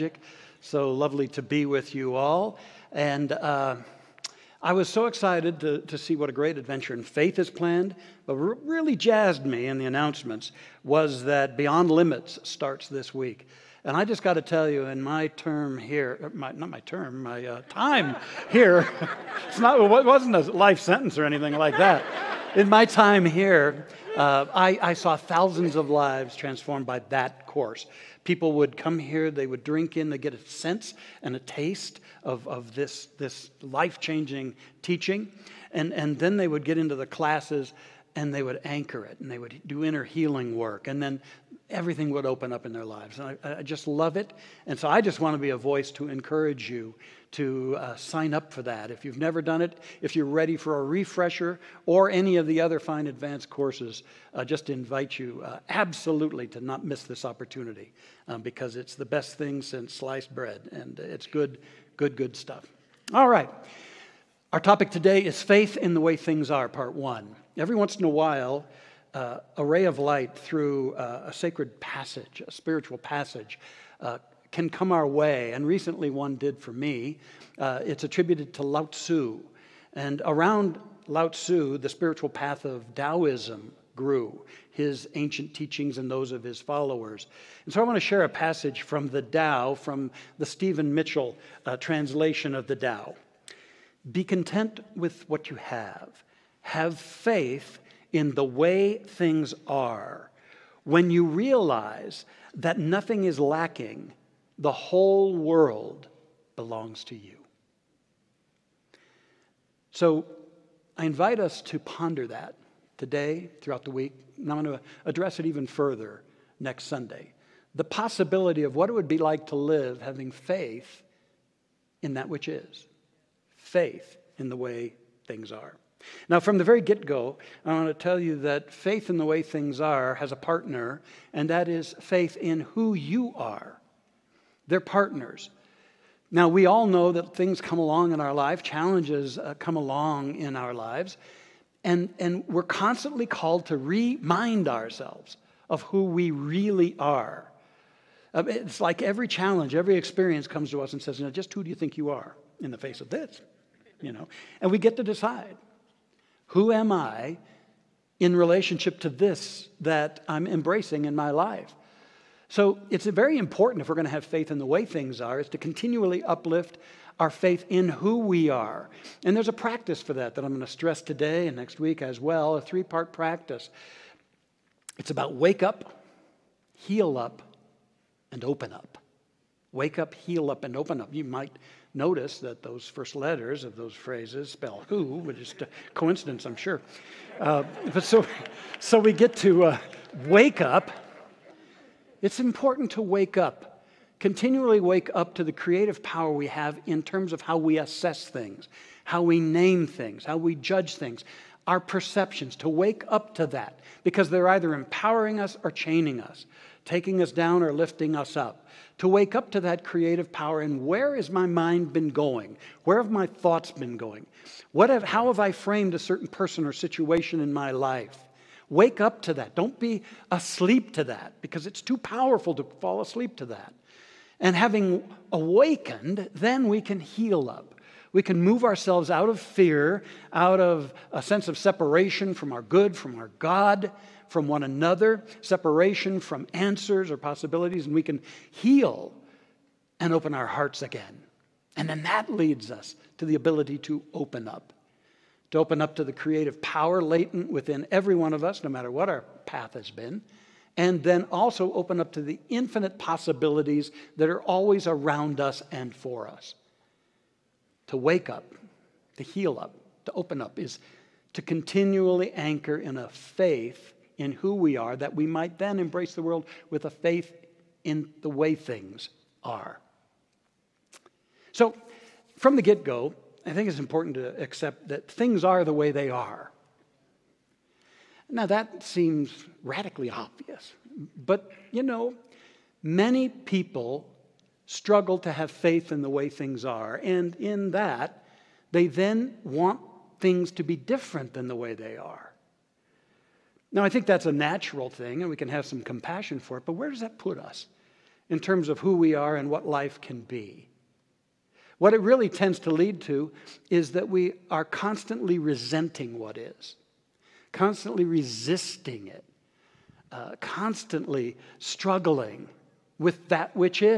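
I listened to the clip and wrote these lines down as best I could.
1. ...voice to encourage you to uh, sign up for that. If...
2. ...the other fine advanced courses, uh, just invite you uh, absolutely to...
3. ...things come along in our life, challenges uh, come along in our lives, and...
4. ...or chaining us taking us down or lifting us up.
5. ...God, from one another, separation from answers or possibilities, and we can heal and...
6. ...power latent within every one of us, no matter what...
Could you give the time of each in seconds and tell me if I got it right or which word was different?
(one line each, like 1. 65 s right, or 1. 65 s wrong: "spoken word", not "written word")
1. 45 s right
2. 52 s right
3. 137 s right
4. 205 s right
5. 233 s right
6. 246 s right.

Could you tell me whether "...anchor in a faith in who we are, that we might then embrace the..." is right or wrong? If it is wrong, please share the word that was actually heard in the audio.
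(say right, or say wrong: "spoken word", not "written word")
right.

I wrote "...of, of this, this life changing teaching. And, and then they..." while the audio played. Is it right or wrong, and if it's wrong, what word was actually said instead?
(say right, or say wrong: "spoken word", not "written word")
right.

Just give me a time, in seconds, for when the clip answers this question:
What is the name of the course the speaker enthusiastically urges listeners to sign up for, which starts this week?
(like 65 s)
11 s.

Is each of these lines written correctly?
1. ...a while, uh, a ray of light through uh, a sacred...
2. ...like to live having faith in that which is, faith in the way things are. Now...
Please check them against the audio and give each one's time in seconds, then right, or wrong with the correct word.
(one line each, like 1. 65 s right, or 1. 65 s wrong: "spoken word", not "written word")
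1. 68 s right
2. 119 s right.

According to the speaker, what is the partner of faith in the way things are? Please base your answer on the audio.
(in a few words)
faith in who you are.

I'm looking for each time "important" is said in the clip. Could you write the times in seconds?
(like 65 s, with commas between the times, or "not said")
163 s, 192 s, 273 s.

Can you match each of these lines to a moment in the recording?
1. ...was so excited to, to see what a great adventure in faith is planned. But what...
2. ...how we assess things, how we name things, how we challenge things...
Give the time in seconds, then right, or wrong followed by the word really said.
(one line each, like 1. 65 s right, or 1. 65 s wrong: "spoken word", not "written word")
1. 4 s right
2. 197 s wrong: "judge", not "challenge".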